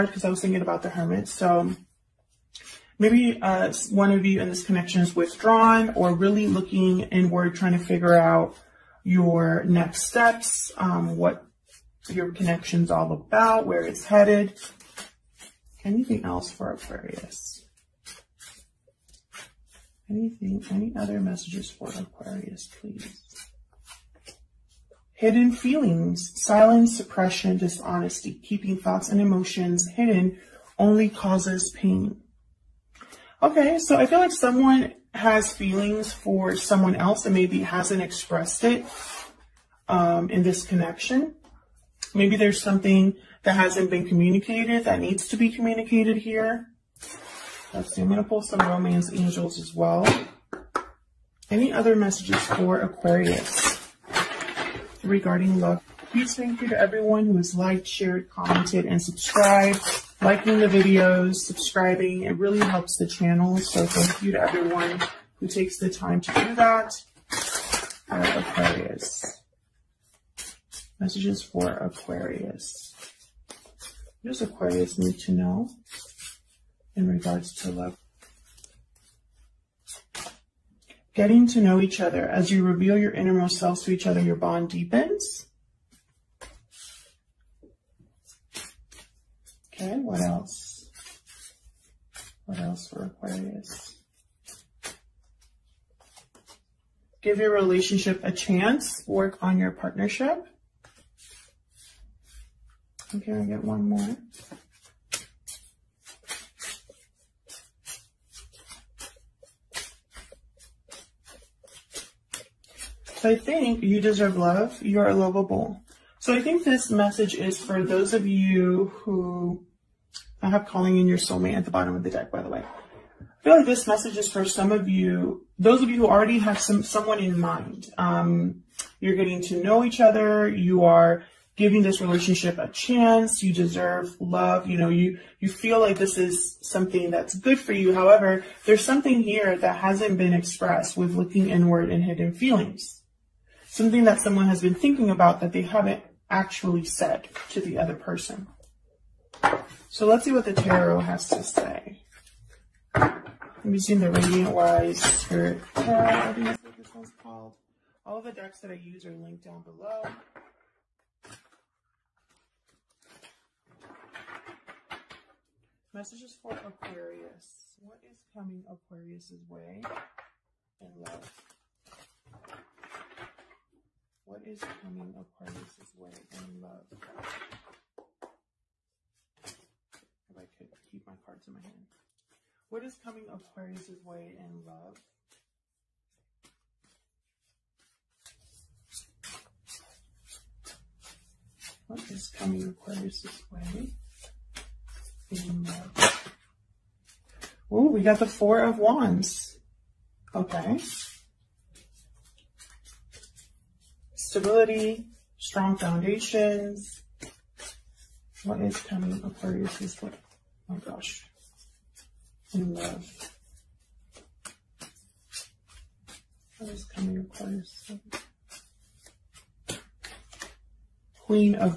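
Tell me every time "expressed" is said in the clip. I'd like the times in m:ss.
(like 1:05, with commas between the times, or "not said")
0:38, 2:20.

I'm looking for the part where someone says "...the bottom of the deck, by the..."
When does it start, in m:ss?
2:01.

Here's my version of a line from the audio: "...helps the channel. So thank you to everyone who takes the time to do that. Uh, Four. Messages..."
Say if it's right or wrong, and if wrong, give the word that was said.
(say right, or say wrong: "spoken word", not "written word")
wrong: "Aquarius", not "Four".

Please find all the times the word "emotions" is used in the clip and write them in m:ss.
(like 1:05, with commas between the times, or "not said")
0:29.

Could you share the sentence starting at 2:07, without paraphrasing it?
Um, you're getting to know each other.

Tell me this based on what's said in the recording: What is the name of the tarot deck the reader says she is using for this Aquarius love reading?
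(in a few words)
Radiant Wise Spirit Tarot.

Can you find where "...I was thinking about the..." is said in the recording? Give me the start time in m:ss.
0:00.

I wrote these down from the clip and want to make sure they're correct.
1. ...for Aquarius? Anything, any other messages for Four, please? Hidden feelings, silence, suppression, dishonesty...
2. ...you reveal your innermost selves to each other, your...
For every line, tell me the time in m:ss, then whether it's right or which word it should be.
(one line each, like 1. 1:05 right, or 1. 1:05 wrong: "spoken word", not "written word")
1. 0:16 wrong: "Aquarius", not "Four"
2. 1:22 right.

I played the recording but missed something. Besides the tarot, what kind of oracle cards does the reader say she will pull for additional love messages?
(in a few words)
romance angels.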